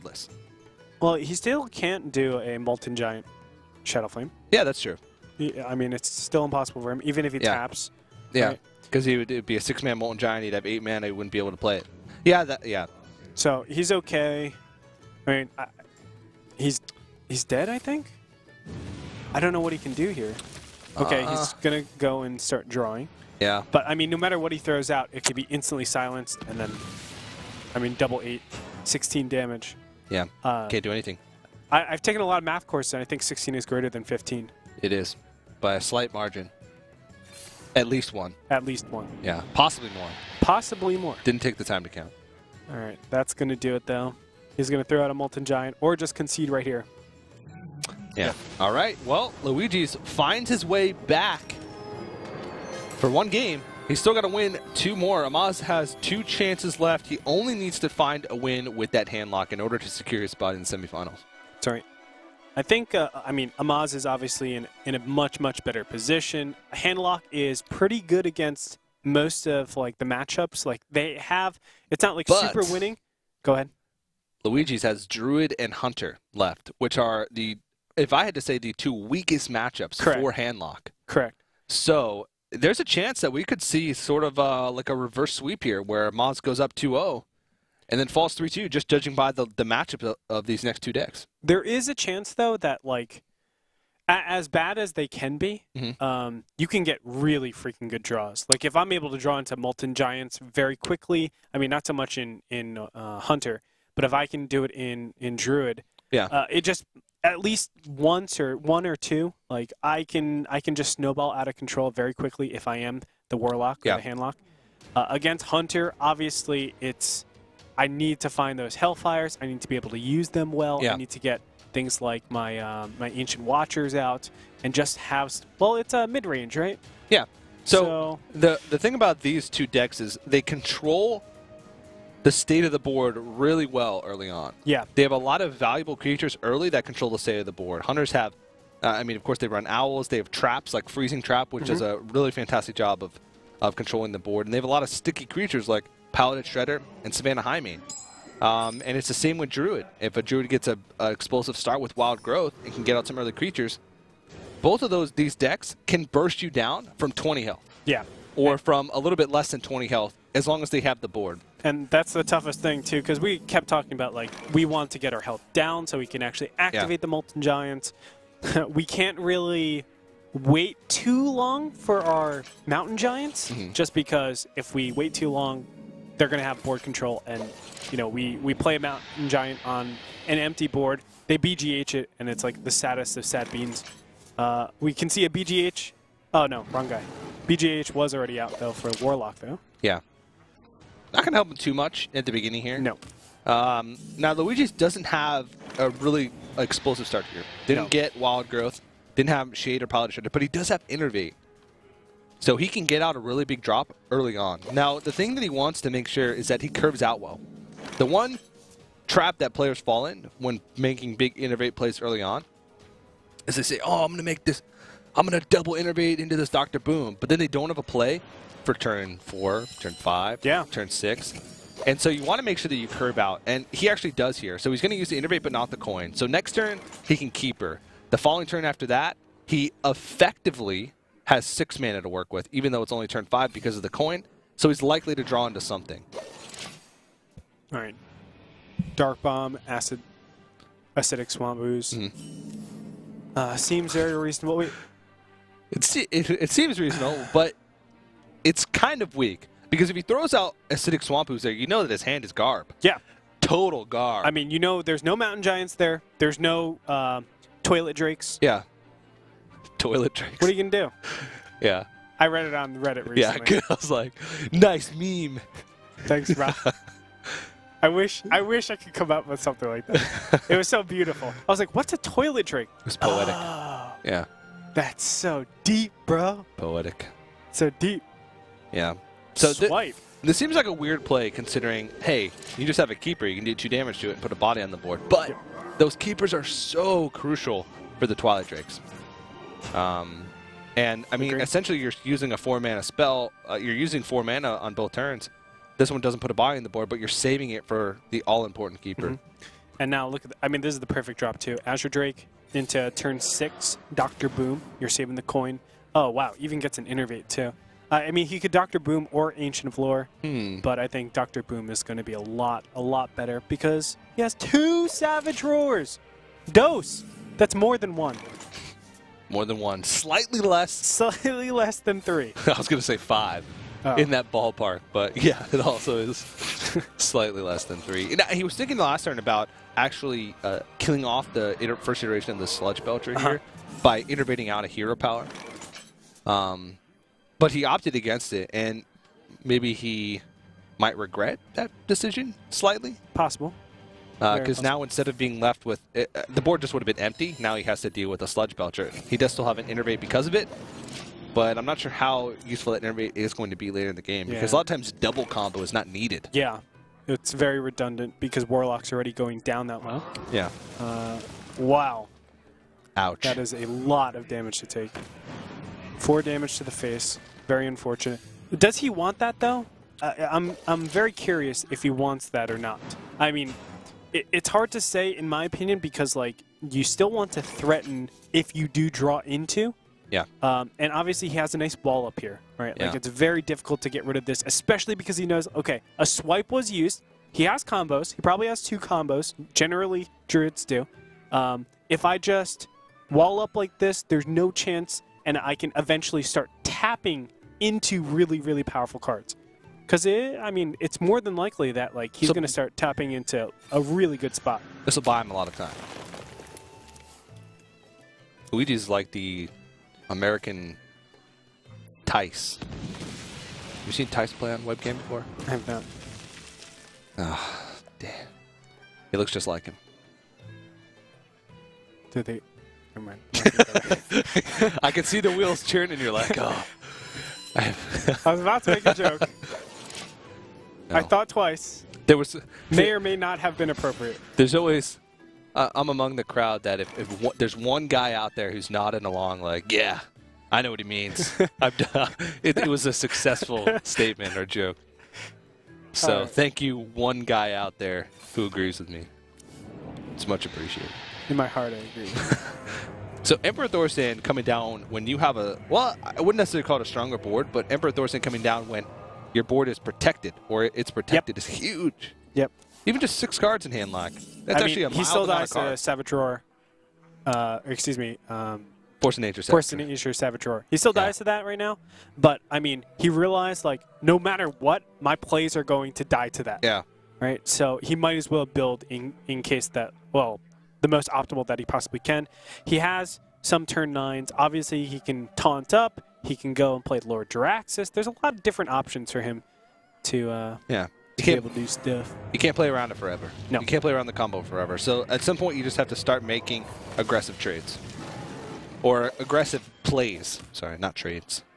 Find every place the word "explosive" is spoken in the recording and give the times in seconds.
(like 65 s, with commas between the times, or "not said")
150 s, 196 s.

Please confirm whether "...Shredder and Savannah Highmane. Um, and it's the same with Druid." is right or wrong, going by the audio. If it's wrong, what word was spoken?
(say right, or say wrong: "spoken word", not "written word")
right.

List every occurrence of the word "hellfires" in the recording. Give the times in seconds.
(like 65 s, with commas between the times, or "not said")
118 s.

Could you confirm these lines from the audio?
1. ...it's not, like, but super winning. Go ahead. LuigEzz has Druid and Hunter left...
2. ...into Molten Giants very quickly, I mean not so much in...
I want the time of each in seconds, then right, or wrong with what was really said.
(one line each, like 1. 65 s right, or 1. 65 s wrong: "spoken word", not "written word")
1. 71 s right
2. 99 s right.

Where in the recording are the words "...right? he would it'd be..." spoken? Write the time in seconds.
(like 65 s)
9 s.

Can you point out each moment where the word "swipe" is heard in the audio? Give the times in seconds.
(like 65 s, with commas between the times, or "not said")
279 s, 386 s.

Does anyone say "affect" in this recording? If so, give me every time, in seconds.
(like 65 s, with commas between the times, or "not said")
not said.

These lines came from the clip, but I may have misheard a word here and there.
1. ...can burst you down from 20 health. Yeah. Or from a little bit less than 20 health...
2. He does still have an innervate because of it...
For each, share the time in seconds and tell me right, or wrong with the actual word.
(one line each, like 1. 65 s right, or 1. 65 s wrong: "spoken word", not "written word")
1. 155 s right
2. 349 s right.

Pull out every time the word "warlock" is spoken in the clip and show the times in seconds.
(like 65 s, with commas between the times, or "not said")
113 s, 189 s, 358 s.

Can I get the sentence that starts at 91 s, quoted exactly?
There is a chance though that like as bad as they can be, mm -hmm.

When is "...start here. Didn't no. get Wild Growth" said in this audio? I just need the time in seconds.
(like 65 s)
197 s.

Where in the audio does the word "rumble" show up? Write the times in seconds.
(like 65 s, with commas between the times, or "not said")
not said.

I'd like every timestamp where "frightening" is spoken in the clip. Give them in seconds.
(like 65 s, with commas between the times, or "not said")
not said.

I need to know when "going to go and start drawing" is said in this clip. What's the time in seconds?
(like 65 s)
21 s.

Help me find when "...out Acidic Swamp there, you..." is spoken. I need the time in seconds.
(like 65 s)
250 s.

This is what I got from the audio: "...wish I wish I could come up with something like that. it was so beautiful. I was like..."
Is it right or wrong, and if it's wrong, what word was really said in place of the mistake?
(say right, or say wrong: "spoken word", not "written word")
right.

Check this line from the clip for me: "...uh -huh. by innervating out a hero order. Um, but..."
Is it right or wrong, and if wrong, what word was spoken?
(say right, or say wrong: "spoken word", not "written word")
wrong: "power", not "order".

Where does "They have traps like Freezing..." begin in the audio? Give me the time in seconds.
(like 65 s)
140 s.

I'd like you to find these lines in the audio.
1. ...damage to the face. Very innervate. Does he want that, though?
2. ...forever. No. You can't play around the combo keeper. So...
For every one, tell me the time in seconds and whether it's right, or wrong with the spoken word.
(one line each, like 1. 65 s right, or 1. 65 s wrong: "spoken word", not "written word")
1. 366 s wrong: "unfortunate", not "innervate"
2. 492 s wrong: "forever", not "keeper".